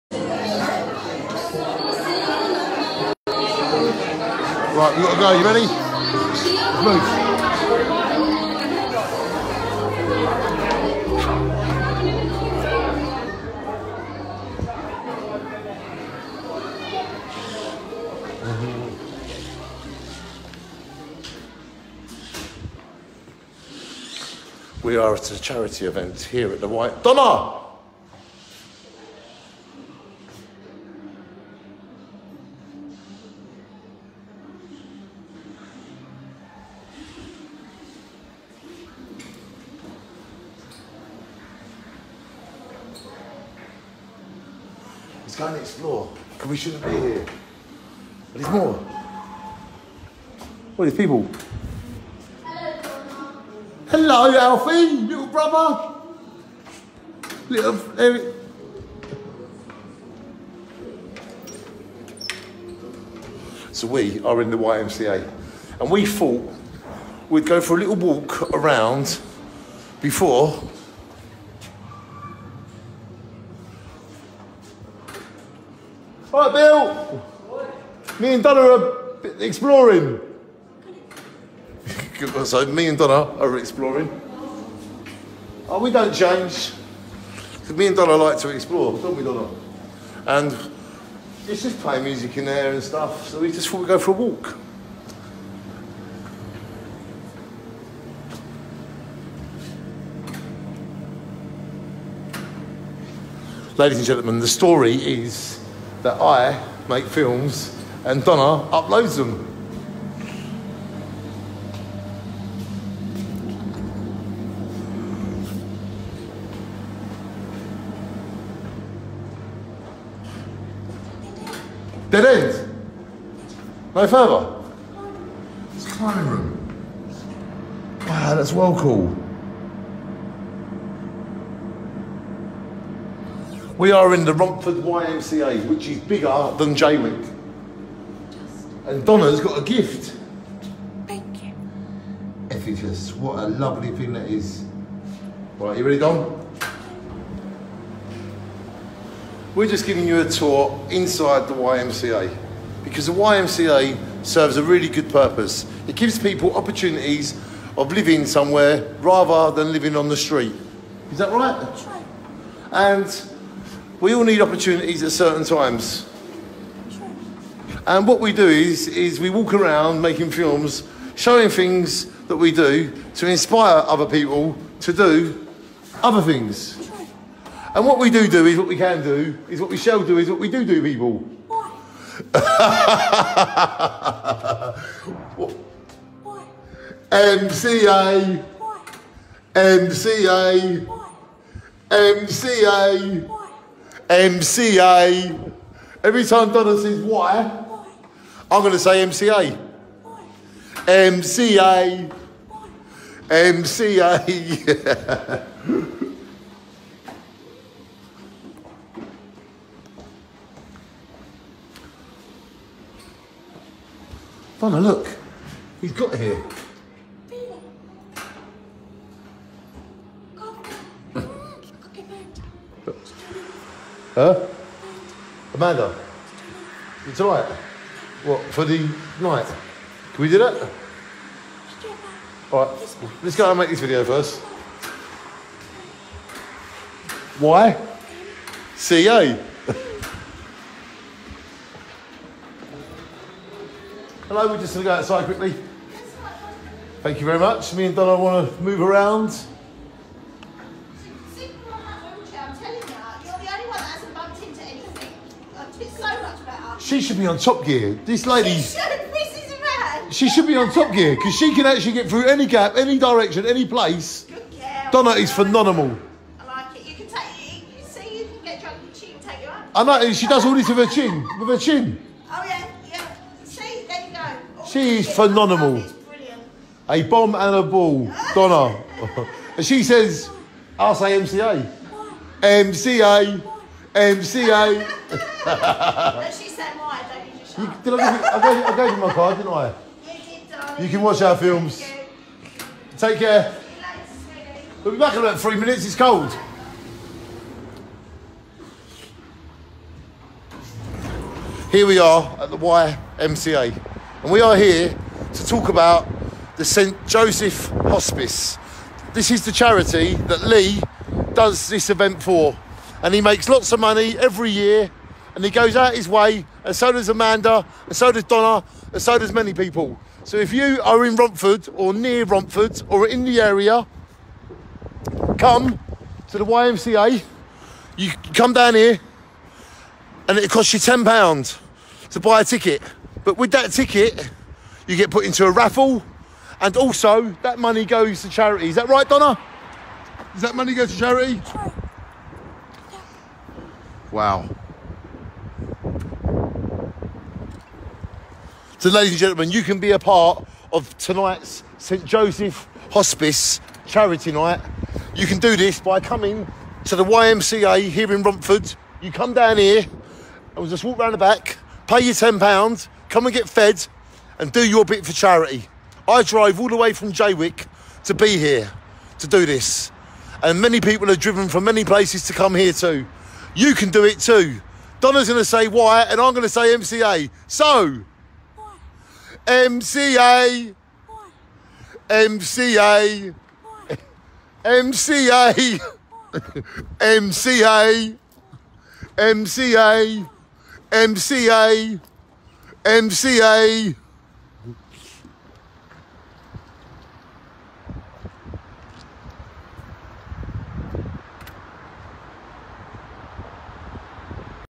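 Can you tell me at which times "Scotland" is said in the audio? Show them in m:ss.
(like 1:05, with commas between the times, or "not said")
not said.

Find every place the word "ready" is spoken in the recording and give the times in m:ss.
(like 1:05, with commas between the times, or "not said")
0:05, 2:25.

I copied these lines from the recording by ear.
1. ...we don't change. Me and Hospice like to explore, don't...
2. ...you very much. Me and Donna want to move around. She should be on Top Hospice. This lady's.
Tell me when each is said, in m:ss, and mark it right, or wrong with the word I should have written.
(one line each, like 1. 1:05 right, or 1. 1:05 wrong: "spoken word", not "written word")
1. 1:25 wrong: "Donna", not "Hospice"
2. 4:07 wrong: "Gear", not "Hospice".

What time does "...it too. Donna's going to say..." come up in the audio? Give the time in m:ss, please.
6:14.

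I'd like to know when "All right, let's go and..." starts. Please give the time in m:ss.
3:52.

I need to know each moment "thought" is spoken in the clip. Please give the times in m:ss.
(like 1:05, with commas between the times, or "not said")
1:06, 1:33.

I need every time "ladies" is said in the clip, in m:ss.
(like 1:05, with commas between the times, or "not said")
1:43, 5:48.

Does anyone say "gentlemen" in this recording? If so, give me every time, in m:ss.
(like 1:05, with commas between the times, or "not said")
1:44, 5:49.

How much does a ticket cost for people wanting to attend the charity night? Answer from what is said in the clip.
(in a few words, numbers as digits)
£10.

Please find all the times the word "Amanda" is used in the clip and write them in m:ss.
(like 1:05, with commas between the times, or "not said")
3:45, 5:17.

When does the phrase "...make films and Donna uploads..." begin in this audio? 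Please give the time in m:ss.
1:46.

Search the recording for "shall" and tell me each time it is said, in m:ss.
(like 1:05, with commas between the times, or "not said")
2:59.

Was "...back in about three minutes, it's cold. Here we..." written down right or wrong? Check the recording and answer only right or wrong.
right.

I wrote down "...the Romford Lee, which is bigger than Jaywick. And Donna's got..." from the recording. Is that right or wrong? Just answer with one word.
wrong.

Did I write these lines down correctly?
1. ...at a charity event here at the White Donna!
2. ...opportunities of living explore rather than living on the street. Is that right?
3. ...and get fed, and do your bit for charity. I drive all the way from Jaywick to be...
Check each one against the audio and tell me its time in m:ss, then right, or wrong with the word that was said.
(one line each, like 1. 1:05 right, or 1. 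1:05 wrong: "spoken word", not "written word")
1. 0:25 right
2. 2:36 wrong: "somewhere", not "explore"
3. 6:03 right.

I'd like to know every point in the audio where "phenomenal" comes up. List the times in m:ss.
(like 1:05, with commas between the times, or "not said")
4:25, 4:35.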